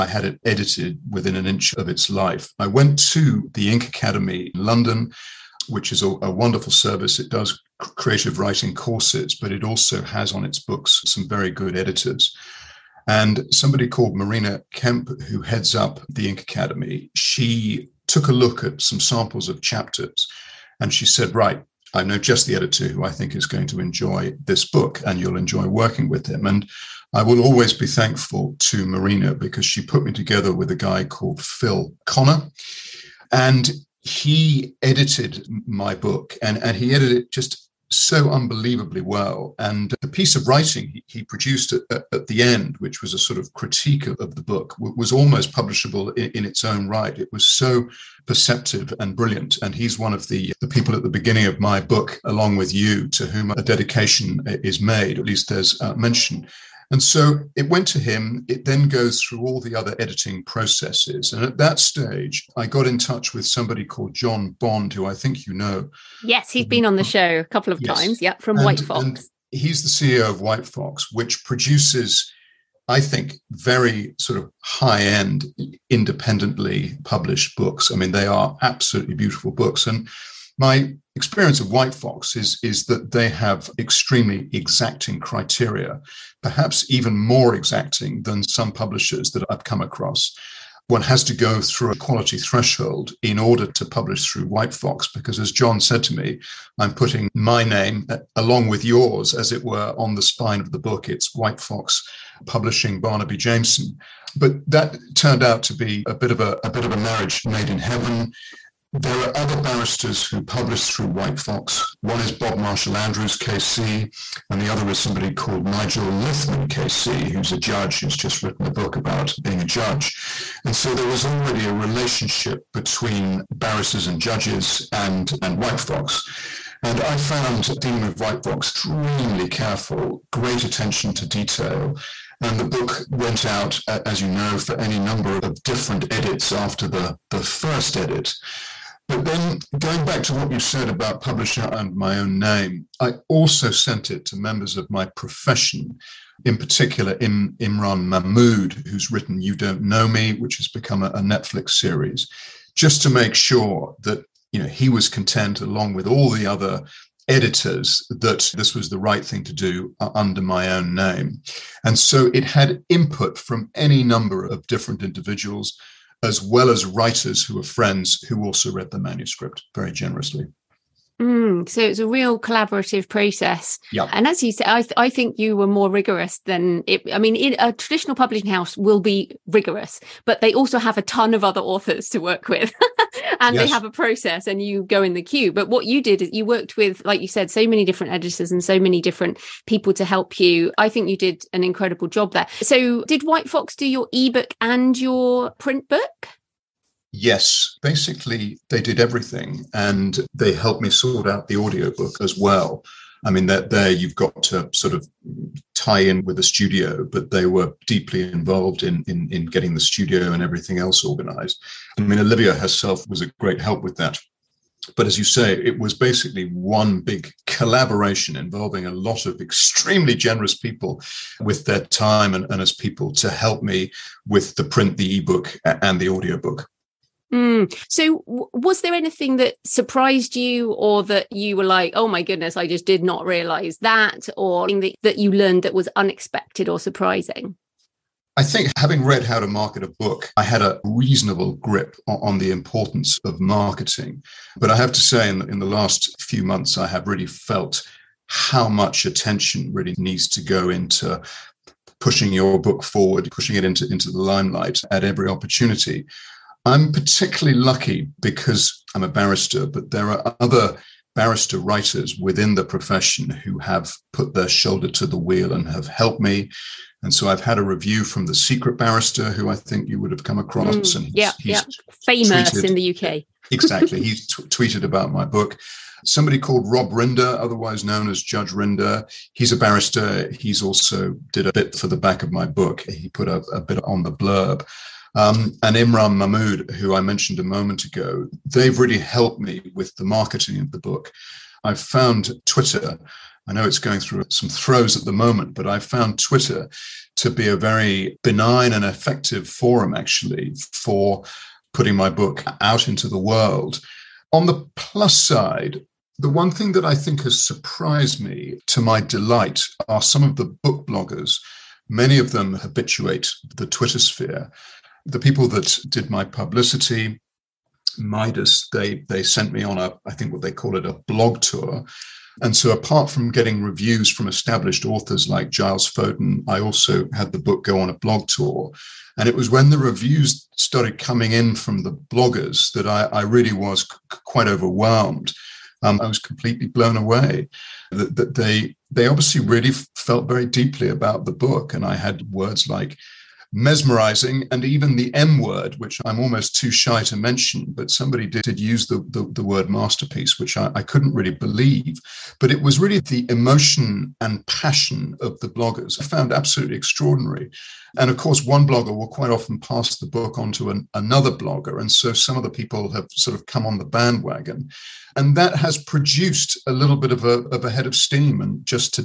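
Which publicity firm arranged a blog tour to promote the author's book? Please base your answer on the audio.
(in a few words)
Midas.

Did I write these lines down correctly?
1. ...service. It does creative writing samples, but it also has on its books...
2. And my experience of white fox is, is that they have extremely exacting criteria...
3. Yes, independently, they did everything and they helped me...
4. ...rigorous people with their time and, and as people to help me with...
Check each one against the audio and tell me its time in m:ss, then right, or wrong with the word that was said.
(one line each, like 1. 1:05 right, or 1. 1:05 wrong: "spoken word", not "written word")
1. 0:06 wrong: "courses", not "samples"
2. 1:19 right
3. 3:17 wrong: "basically", not "independently"
4. 3:40 wrong: "generous", not "rigorous".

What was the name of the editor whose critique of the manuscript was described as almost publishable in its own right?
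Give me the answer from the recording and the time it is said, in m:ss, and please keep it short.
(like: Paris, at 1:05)
Phil Connor, at 0:31.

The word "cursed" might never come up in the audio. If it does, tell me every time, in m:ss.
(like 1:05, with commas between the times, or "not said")
not said.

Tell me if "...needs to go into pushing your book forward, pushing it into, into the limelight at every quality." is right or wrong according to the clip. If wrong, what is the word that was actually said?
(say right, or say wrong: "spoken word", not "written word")
wrong: "opportunity", not "quality".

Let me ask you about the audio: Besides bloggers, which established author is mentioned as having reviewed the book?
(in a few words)
Giles Foden.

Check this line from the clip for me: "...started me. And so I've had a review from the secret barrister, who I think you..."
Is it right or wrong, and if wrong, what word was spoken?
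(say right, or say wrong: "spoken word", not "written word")
wrong: "helped", not "started".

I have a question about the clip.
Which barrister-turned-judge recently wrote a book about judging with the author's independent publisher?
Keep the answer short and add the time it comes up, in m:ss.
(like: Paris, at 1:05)
Nigel Lithman, at 1:55.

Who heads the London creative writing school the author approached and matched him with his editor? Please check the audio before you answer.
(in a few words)
Marina Kemp.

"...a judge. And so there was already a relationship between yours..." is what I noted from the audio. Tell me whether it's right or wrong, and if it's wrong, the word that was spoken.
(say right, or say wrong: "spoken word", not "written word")
wrong: "barristers", not "yours".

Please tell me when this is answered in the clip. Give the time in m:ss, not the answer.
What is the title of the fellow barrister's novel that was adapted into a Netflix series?
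2:29.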